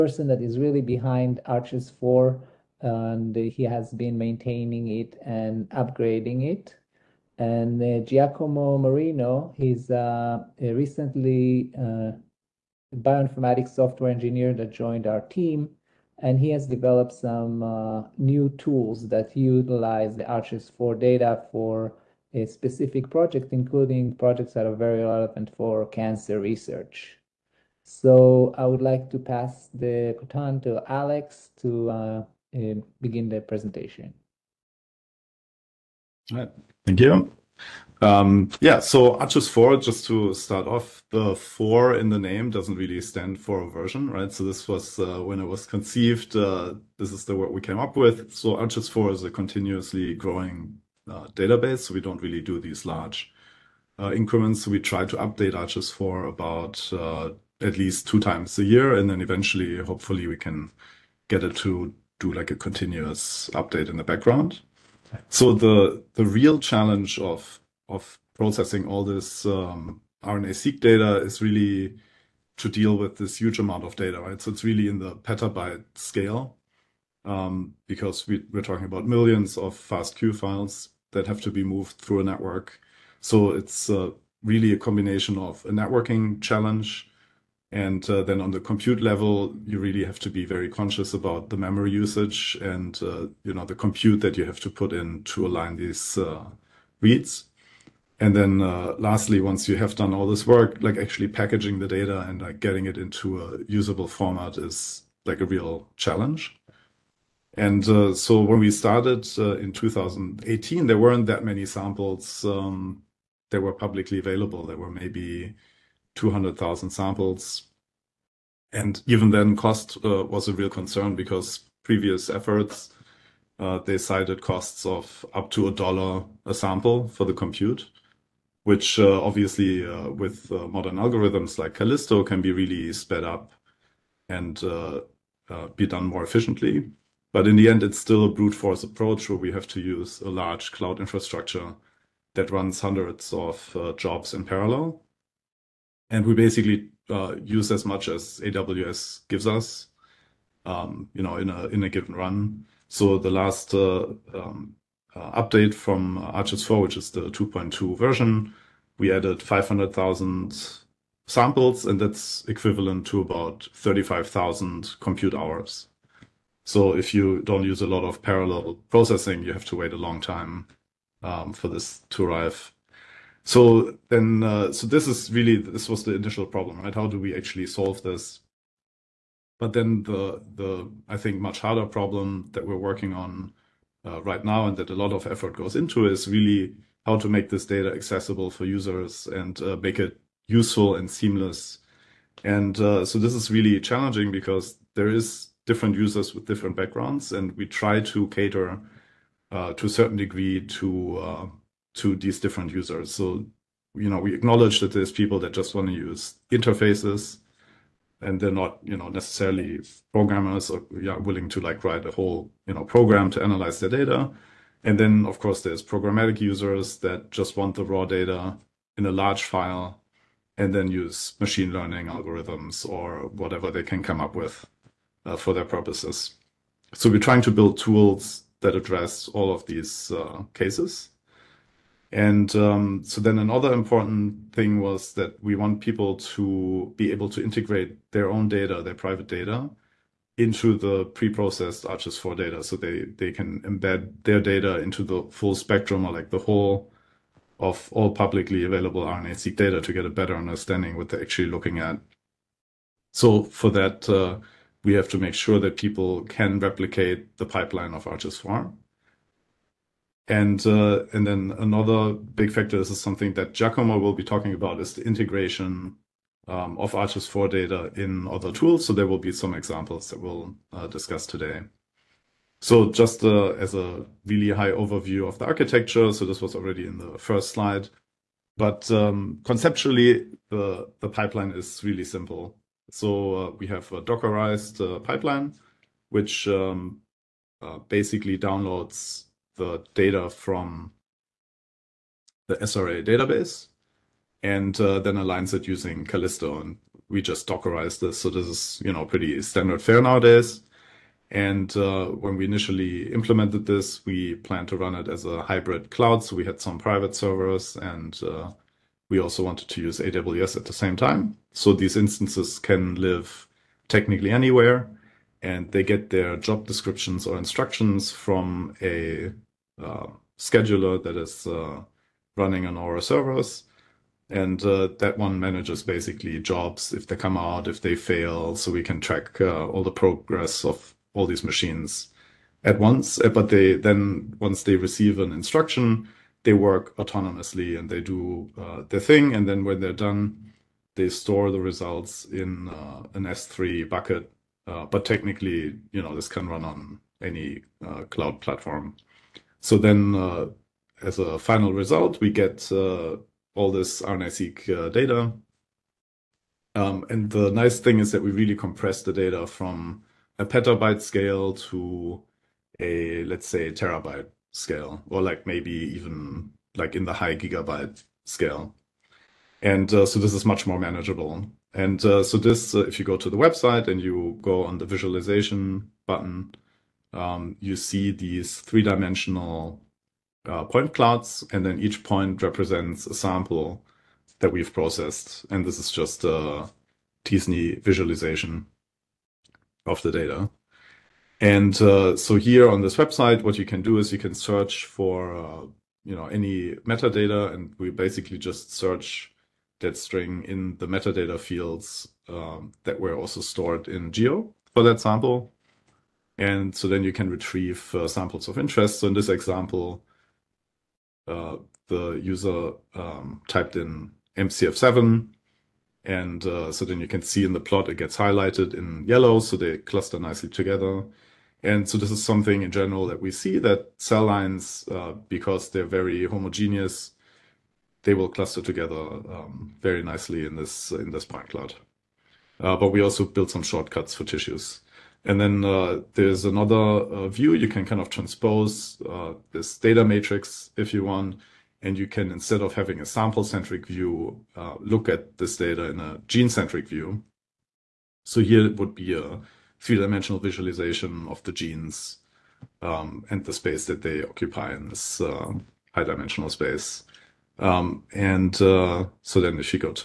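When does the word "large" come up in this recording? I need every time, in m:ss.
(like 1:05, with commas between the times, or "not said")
0:52, 2:20, 3:39.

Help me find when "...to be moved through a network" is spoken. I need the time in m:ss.
1:21.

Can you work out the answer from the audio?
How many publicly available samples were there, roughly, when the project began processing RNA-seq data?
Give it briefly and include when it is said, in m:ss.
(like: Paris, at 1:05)
200,000, at 1:56.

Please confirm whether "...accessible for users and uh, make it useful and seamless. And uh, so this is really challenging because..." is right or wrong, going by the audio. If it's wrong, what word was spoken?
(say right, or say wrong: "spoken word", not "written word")
right.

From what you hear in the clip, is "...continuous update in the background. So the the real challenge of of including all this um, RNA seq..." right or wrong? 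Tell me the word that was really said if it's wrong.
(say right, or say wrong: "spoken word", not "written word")
wrong: "processing", not "including".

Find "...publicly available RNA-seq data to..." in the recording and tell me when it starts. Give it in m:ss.
4:08.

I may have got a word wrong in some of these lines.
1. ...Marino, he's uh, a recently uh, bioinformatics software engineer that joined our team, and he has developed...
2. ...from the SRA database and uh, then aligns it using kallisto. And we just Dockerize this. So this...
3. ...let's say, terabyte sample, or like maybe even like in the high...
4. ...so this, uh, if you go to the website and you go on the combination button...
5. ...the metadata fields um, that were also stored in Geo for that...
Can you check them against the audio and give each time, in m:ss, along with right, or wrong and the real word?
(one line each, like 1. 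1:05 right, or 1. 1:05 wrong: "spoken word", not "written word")
1. 0:08 right
2. 4:50 right
3. 6:03 wrong: "scale", not "sample"
4. 6:12 wrong: "visualization", not "combination"
5. 6:40 right.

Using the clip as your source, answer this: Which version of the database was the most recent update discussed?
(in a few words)
2.2.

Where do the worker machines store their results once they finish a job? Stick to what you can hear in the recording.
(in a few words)
an S3 bucket.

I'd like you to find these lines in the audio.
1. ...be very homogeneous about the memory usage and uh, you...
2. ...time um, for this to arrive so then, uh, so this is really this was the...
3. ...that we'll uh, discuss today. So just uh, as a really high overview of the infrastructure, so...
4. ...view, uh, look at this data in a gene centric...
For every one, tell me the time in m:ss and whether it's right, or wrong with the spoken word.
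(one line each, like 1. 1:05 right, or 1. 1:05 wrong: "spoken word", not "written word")
1. 1:30 wrong: "conscious", not "homogeneous"
2. 2:50 right
3. 4:30 wrong: "architecture", not "infrastructure"
4. 7:23 right.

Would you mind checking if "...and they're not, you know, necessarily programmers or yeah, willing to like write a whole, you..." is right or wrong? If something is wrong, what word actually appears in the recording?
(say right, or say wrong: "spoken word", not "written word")
right.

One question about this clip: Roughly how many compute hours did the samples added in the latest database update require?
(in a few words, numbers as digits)
35,000.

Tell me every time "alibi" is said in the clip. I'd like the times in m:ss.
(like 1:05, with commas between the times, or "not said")
not said.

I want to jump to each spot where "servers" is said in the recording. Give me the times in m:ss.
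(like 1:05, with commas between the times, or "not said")
5:07, 5:23.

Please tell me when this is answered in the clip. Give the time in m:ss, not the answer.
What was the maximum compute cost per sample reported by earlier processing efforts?
2:05.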